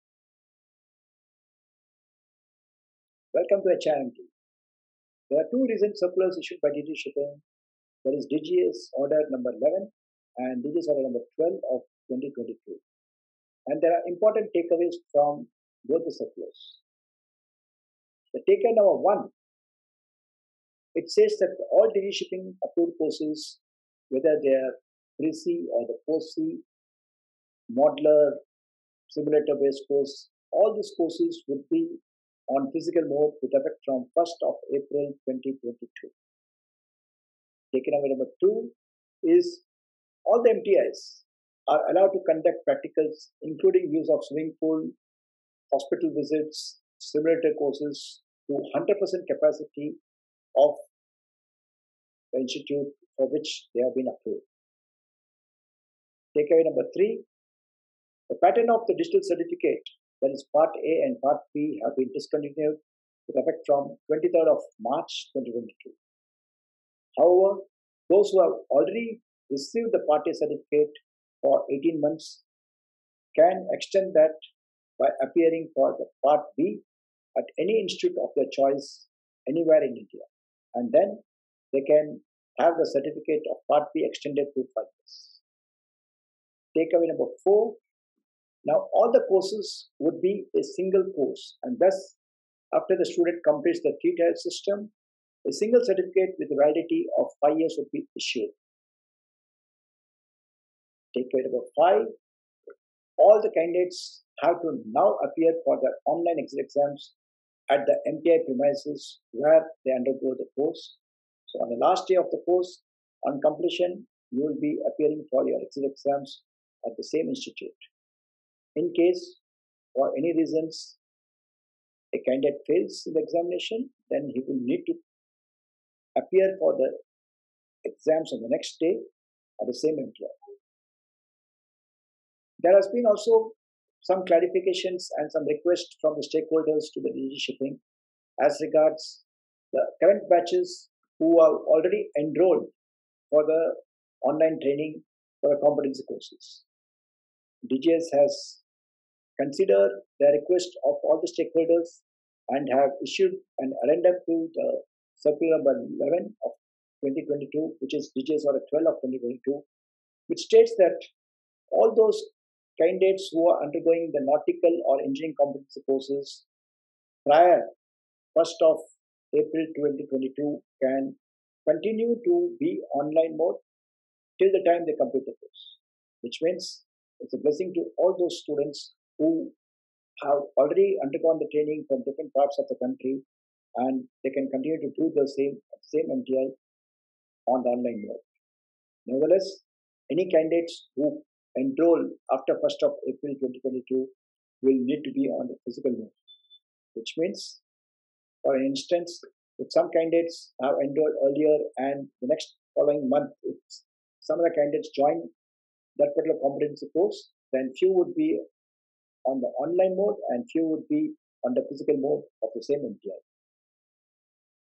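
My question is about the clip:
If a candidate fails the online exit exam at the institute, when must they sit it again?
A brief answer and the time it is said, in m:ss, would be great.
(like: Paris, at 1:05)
The next day, at 2:08.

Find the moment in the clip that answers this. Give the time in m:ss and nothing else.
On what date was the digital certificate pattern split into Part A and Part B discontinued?
1:04.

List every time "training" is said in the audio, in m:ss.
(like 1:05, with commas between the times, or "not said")
2:24, 3:01.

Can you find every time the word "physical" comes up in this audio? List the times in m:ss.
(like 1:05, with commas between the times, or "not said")
0:32, 3:15, 3:31.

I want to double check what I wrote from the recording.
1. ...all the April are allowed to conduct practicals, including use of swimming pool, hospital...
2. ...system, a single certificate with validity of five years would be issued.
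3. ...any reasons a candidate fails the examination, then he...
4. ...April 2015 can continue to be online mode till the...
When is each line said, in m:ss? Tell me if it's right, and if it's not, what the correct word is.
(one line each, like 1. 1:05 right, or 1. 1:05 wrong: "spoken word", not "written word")
1. 0:40 wrong: "MTIs", not "April"
2. 1:34 right
3. 2:00 right
4. 2:49 wrong: "2022", not "2015".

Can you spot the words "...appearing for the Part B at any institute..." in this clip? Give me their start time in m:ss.
1:15.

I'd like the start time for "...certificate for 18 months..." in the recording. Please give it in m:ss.
1:10.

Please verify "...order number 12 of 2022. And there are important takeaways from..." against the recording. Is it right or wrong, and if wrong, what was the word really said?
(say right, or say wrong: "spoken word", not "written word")
right.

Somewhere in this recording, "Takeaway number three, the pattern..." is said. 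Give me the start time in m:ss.
0:56.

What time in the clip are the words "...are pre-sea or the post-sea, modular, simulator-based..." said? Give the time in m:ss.
0:24.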